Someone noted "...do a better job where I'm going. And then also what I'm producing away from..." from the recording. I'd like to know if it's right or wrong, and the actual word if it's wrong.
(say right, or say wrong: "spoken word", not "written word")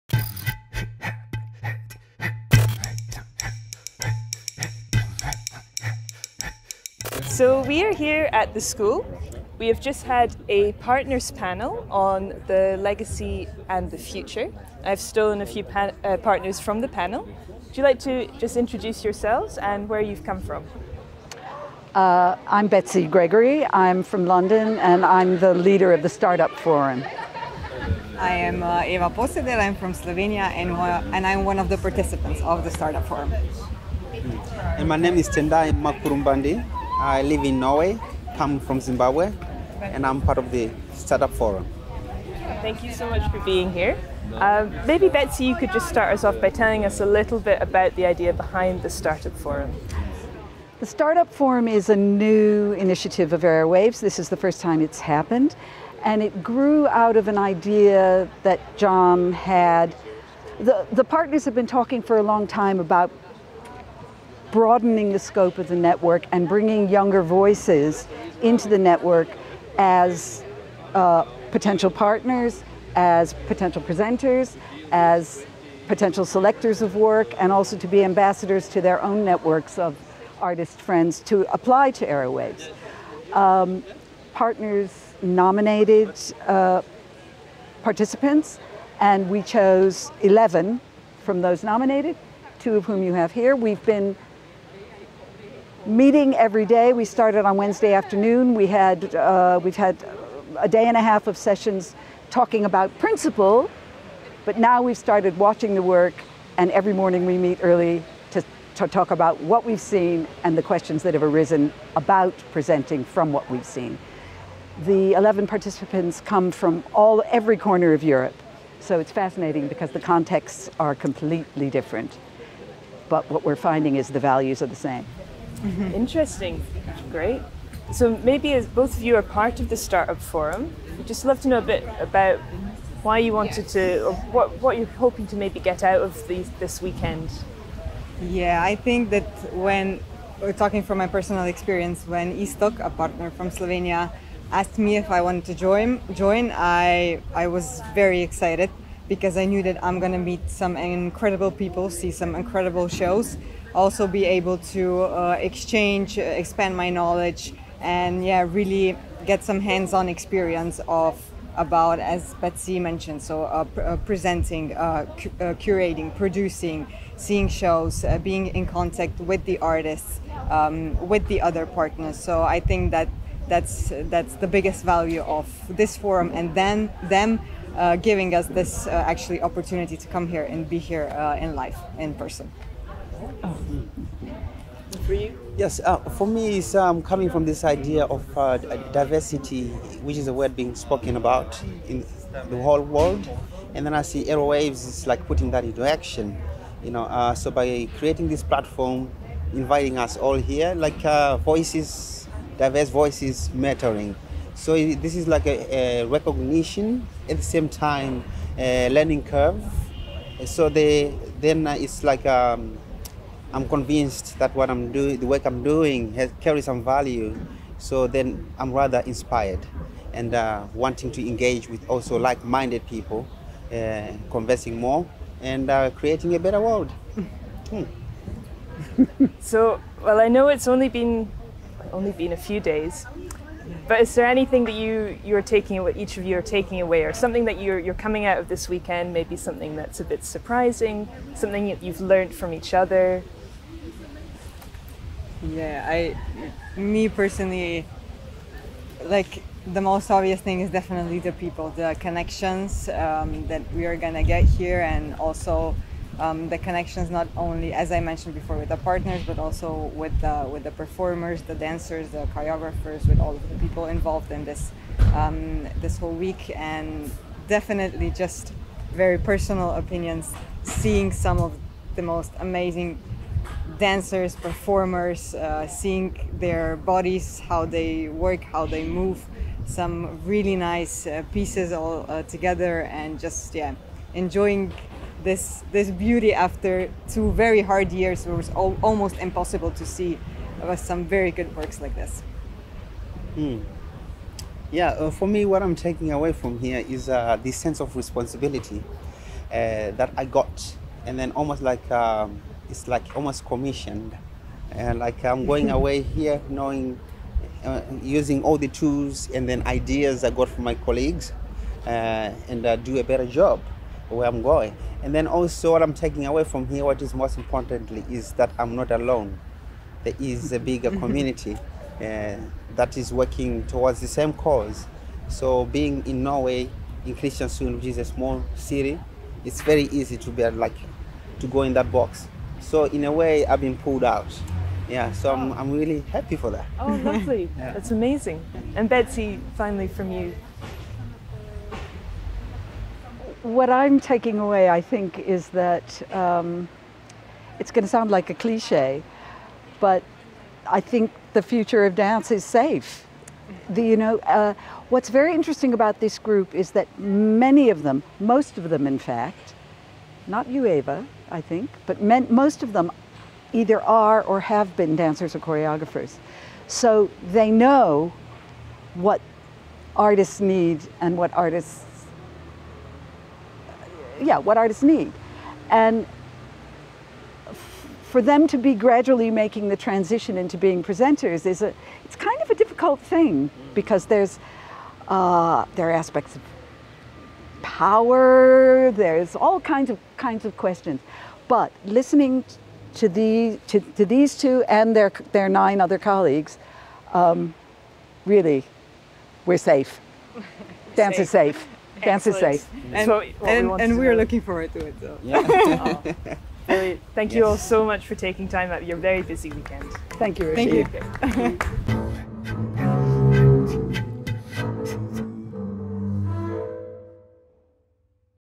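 wrong: "taking", not "producing".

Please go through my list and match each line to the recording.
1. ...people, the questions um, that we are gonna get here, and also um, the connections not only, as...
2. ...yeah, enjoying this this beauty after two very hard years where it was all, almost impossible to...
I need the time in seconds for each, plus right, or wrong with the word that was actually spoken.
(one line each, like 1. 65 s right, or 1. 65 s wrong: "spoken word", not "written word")
1. 251 s wrong: "connections", not "questions"
2. 283 s right.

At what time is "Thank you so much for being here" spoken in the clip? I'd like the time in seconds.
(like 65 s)
42 s.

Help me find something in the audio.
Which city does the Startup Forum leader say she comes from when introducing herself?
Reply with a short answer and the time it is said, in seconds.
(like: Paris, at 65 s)
London, at 24 s.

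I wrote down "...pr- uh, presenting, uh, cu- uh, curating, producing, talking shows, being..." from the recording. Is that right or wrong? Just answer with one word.
wrong.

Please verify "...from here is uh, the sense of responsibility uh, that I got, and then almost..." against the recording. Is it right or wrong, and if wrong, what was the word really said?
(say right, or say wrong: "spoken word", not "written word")
right.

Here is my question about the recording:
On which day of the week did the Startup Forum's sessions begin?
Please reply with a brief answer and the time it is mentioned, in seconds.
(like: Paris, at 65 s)
Wednesday, at 97 s.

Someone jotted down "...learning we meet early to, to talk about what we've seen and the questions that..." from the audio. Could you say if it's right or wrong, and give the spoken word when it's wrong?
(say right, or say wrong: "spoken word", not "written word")
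wrong: "morning", not "learning".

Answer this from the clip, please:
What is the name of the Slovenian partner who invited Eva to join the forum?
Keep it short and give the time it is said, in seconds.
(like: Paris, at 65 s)
Istok, at 142 s.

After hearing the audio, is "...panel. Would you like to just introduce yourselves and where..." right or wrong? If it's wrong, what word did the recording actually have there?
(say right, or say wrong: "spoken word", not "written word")
right.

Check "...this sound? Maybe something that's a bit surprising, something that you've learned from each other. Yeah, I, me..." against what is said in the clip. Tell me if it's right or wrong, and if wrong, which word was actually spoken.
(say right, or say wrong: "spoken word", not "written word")
wrong: "weekend", not "sound".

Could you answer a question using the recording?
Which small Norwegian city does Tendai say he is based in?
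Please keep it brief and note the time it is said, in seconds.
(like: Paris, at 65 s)
Kristiansund, at 327 s.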